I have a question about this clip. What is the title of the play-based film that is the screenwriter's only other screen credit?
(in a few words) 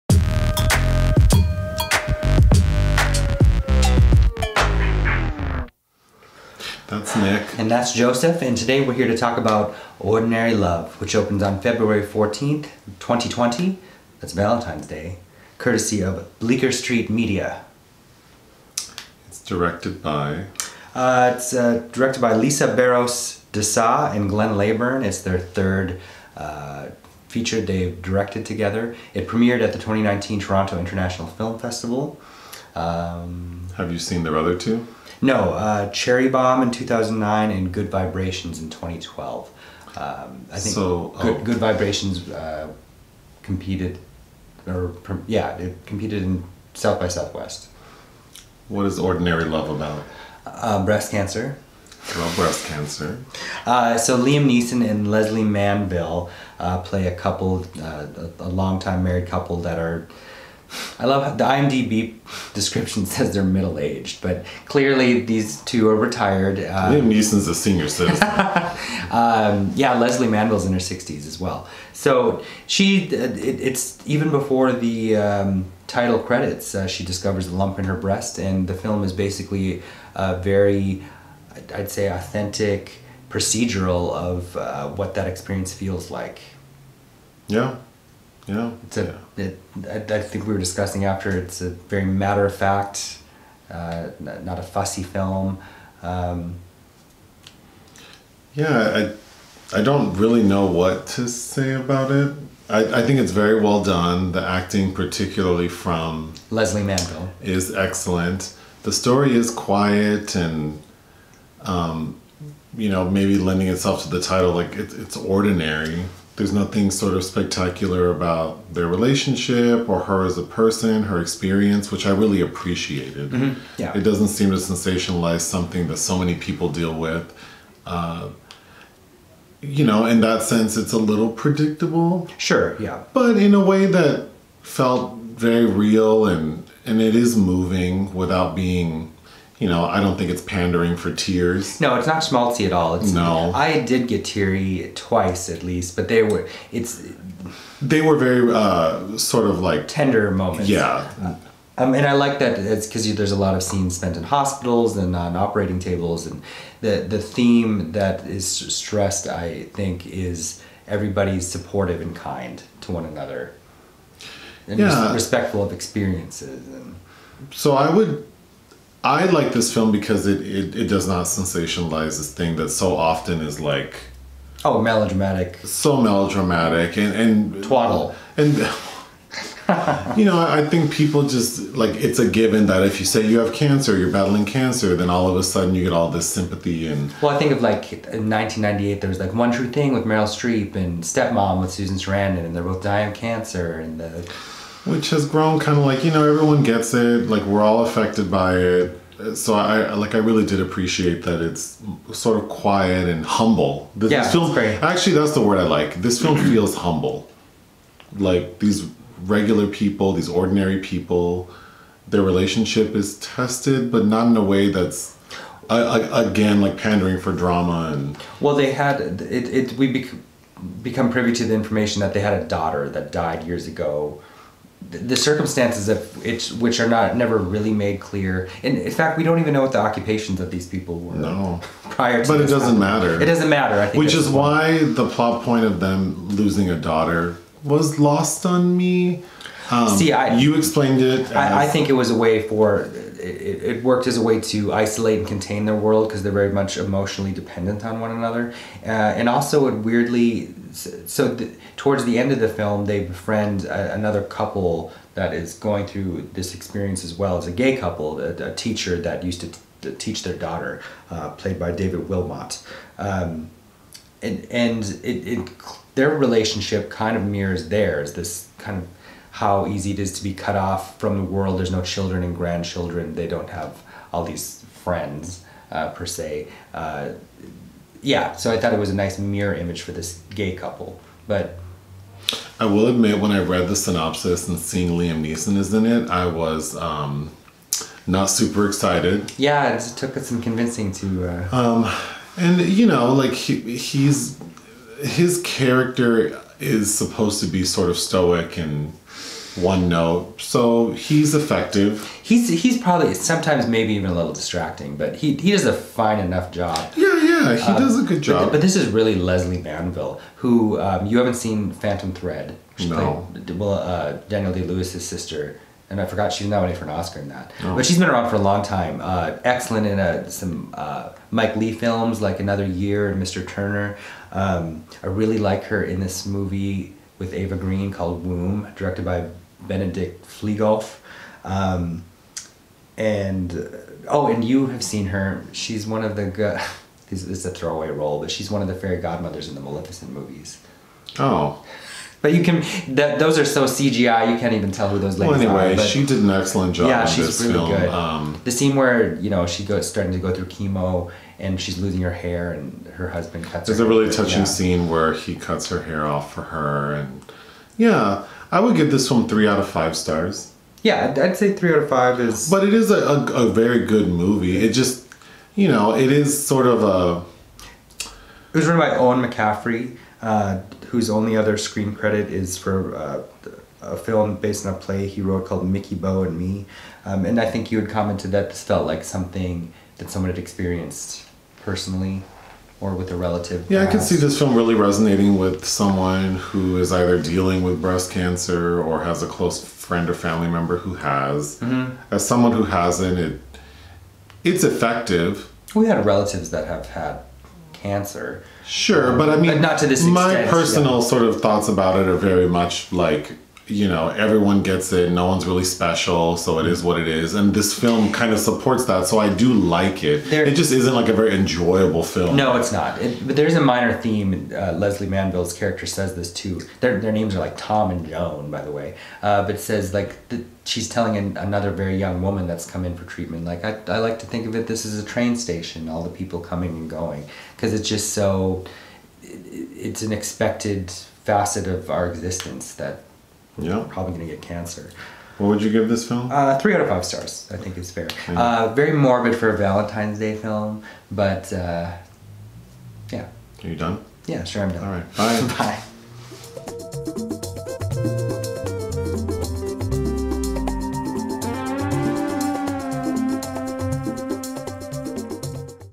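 Mickybo and Me.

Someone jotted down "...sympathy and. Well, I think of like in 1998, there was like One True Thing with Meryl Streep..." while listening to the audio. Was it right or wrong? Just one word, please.
right.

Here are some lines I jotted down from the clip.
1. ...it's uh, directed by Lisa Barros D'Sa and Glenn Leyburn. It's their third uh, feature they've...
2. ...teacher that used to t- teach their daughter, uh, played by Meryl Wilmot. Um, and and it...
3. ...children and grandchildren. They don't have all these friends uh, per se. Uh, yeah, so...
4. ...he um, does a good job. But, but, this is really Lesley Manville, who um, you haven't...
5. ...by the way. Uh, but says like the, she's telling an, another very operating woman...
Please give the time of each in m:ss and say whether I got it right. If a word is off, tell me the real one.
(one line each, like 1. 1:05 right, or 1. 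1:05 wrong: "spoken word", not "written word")
1. 0:21 right
2. 4:18 wrong: "David", not "Meryl"
3. 4:31 right
4. 5:07 right
5. 6:58 wrong: "young", not "operating".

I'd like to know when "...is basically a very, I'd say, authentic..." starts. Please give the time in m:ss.
1:19.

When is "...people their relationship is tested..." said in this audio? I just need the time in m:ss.
3:30.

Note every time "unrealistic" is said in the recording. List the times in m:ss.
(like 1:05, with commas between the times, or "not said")
not said.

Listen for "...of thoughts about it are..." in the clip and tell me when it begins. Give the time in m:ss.
6:41.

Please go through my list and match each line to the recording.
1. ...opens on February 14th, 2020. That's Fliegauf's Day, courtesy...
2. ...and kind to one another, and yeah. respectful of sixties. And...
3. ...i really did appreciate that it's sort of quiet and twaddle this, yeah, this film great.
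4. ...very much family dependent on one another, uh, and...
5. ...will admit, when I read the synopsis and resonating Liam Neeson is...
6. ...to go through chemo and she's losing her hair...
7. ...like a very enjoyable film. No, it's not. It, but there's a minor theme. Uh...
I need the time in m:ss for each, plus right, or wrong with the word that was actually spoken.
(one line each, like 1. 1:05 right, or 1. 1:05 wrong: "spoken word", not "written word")
1. 0:11 wrong: "Valentine", not "Fliegauf"
2. 2:42 wrong: "experiences", not "sixties"
3. 3:20 wrong: "humble", not "twaddle"
4. 4:06 wrong: "emotionally", not "family"
5. 4:42 wrong: "seeing", not "resonating"
6. 5:50 right
7. 6:50 right.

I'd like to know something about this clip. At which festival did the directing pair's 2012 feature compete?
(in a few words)
South by Southwest.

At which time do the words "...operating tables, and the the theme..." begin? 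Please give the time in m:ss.
2:35.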